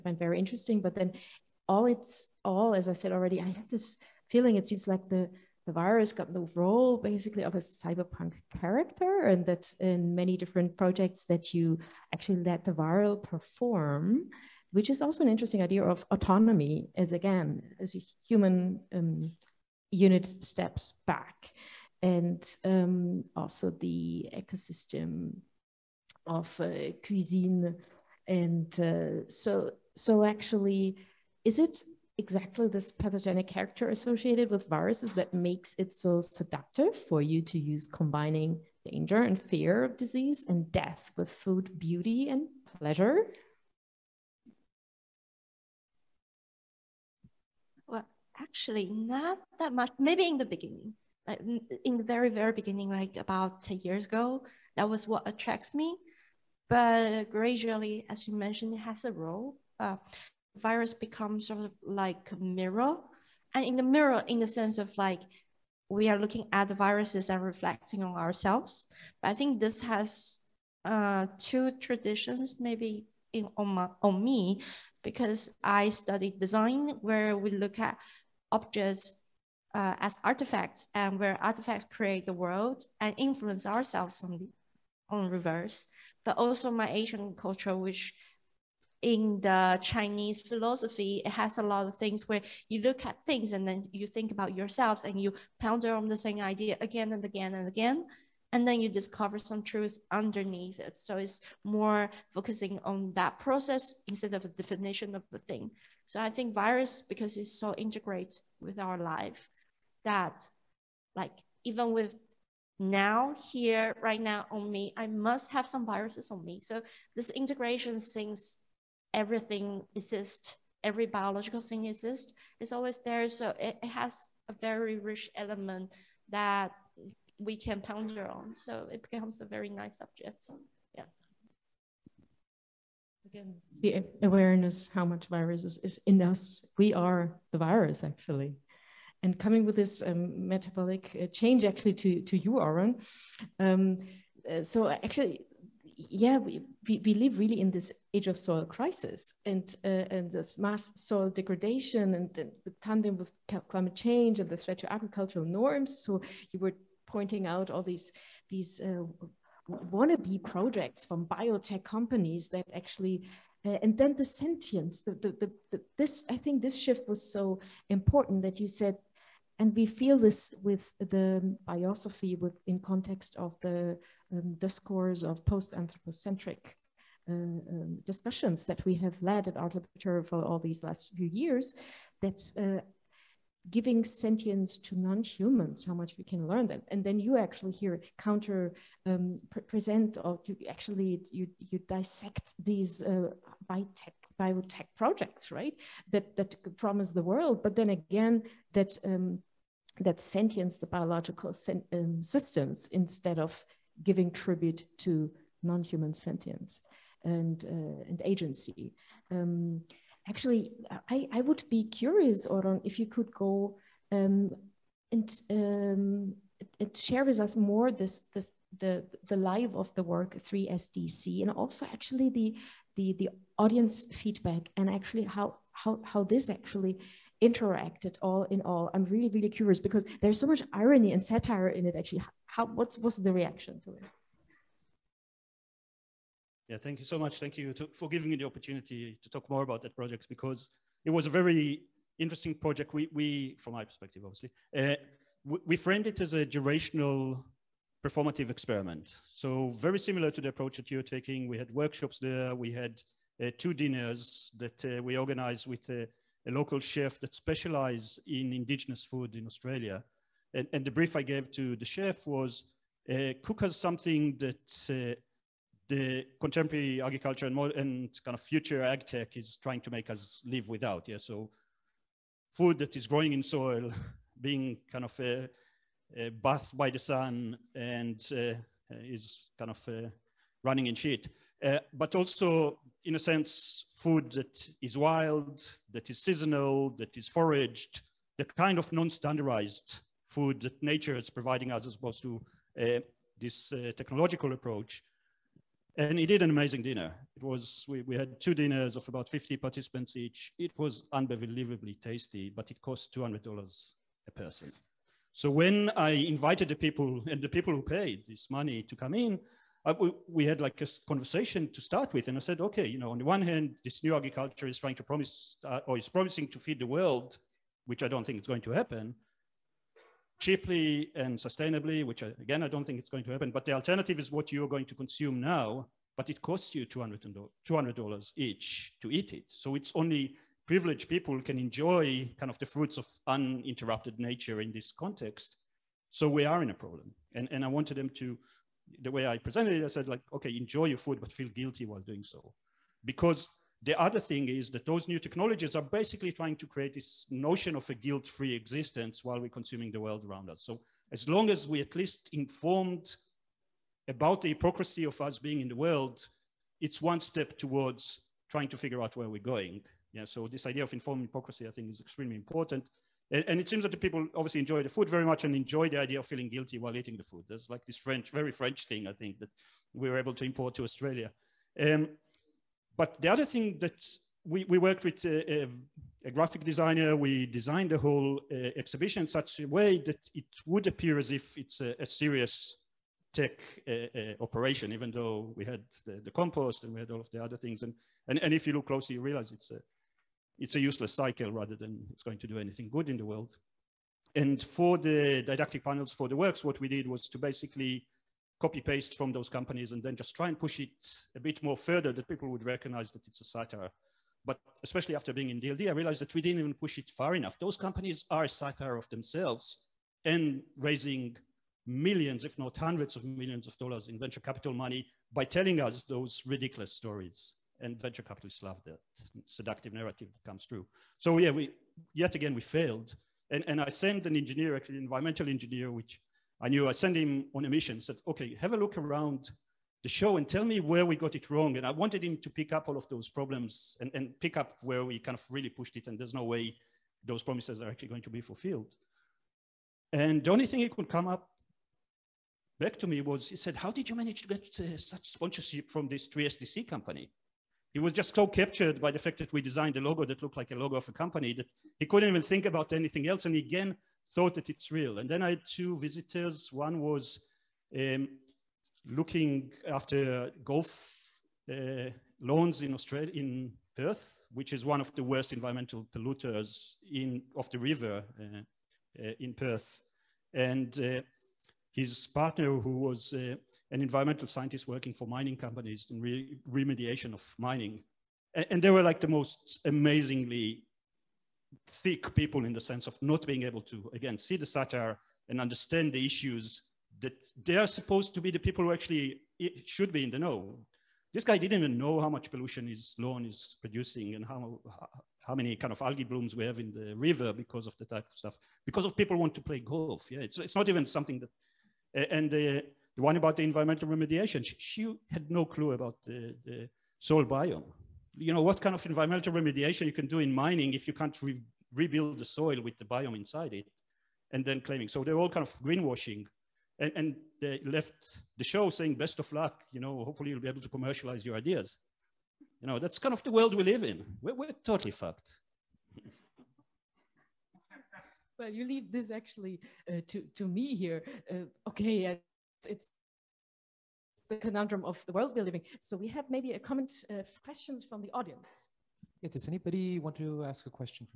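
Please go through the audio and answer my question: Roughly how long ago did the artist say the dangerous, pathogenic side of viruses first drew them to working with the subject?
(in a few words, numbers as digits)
10 years ago.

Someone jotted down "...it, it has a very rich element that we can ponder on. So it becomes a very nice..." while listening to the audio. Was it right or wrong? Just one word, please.
right.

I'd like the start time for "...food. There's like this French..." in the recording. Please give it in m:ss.
6:07.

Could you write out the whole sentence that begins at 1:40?
So it's more focusing on that process instead of a definition of the thing.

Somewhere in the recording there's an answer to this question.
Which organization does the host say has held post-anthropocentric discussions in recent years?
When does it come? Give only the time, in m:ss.
2:59.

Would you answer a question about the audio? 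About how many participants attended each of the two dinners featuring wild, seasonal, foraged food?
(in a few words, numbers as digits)
50.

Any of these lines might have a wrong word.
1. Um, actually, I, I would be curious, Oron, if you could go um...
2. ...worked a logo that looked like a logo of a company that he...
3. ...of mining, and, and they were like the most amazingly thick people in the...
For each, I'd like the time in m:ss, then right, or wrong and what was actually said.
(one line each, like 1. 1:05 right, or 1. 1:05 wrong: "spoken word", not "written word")
1. 3:29 right
2. 7:29 wrong: "designed", not "worked"
3. 7:57 right.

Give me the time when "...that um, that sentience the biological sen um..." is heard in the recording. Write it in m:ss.
3:18.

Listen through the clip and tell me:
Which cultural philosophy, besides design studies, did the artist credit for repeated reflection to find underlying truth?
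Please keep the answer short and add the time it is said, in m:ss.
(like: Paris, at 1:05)
Chinese philosophy, at 1:29.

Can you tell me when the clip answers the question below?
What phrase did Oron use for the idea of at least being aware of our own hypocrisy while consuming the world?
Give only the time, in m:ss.
6:00.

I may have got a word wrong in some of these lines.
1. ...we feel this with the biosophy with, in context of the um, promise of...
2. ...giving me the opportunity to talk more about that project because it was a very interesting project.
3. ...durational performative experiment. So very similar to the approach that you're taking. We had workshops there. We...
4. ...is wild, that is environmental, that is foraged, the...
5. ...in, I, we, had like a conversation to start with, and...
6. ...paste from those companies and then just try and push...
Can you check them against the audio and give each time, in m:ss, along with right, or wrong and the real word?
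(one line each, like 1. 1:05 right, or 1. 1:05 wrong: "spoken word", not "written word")
1. 2:49 wrong: "discourse", not "promise"
2. 3:58 right
3. 4:06 right
4. 4:44 wrong: "seasonal", not "environmental"
5. 5:09 right
6. 6:38 right.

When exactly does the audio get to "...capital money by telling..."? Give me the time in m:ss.
6:54.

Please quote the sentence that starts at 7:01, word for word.
So yeah, we yet again we failed, and and I sent an engineer, actually an environmental engineer, which I knew.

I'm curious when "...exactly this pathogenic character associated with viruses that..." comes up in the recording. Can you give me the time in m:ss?
0:32.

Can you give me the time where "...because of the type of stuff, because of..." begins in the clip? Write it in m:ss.
8:17.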